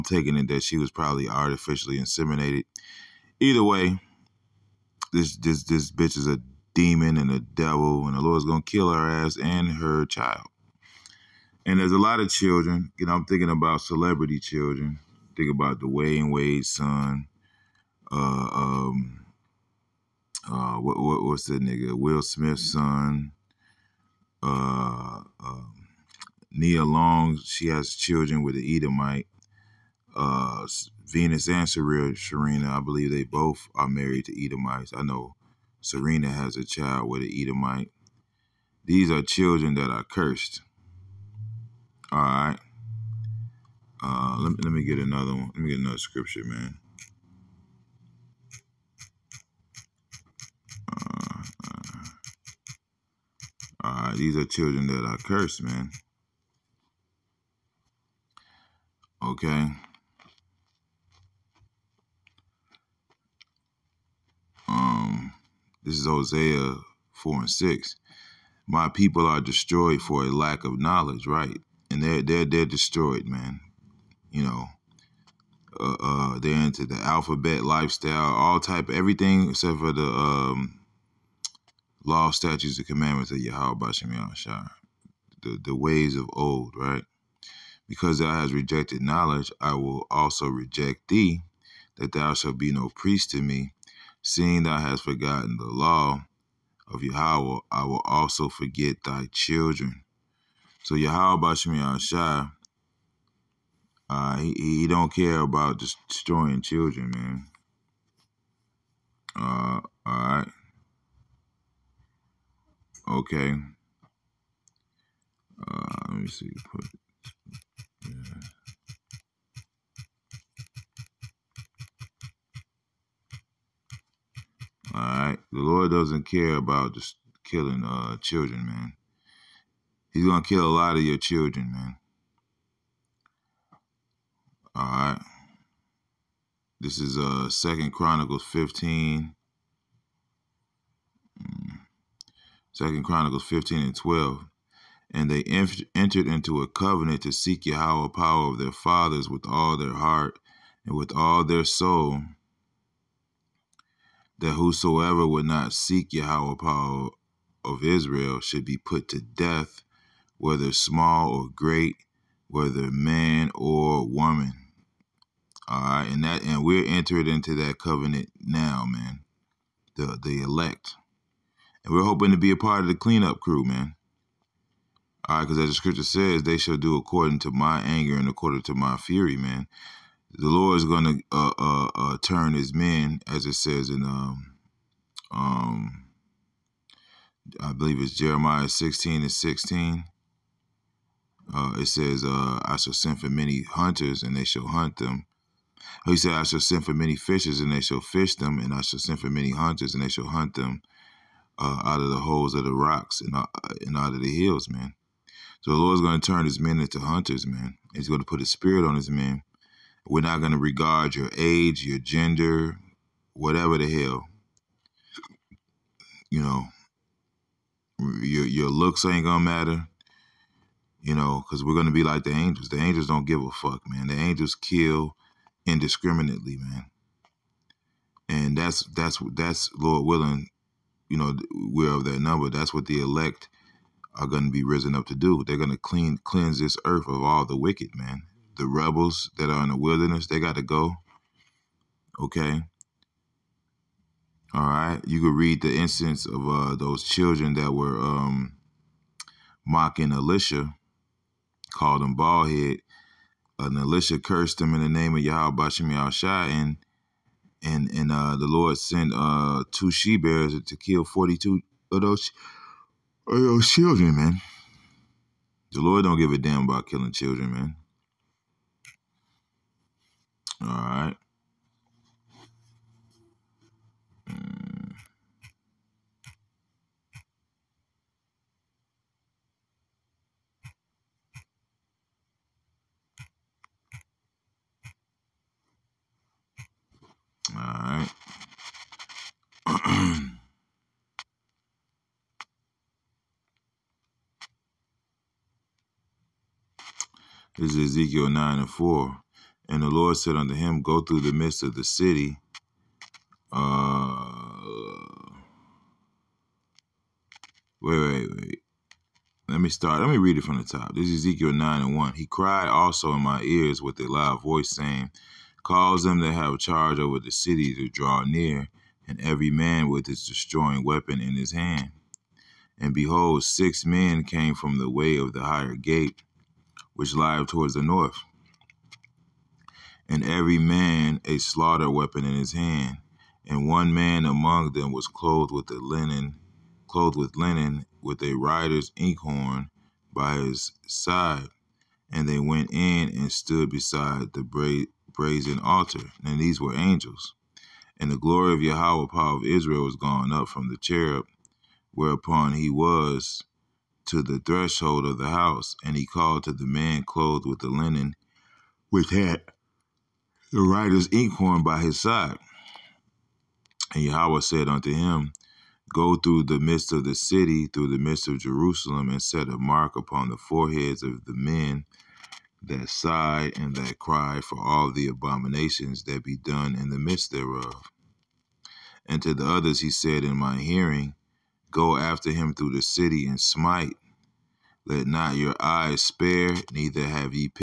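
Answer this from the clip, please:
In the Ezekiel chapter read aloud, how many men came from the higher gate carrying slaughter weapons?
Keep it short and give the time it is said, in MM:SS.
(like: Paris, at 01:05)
6, at 05:23.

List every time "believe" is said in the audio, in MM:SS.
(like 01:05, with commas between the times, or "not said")
00:32, 03:07.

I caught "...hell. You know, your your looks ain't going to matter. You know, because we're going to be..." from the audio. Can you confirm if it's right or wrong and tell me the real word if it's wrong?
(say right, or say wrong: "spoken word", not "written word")
right.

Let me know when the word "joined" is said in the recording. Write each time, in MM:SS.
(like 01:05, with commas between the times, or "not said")
not said.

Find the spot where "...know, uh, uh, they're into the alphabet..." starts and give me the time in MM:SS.
01:14.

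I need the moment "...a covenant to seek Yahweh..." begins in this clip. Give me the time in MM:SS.
02:26.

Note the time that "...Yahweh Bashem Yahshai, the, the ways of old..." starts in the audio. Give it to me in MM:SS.
01:23.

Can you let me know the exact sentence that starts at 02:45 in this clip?
All right, and that and we're entered into that covenant now, man.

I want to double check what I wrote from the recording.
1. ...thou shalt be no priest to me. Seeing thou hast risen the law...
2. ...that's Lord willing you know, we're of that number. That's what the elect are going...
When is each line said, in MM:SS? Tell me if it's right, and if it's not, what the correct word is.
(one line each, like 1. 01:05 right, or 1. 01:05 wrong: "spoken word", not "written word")
1. 01:32 wrong: "forgotten", not "risen"
2. 03:49 right.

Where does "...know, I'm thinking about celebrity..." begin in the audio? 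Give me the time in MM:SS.
00:13.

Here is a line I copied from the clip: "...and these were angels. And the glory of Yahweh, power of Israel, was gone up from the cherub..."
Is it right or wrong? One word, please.
right.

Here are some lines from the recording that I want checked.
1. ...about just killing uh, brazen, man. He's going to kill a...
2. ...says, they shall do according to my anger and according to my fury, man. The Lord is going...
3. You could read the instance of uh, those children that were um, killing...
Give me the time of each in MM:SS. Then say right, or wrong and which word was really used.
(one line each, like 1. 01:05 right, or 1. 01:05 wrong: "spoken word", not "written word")
1. 02:06 wrong: "children", not "brazen"
2. 02:56 right
3. 04:05 wrong: "mocking", not "killing".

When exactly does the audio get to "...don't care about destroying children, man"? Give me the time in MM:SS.
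01:44.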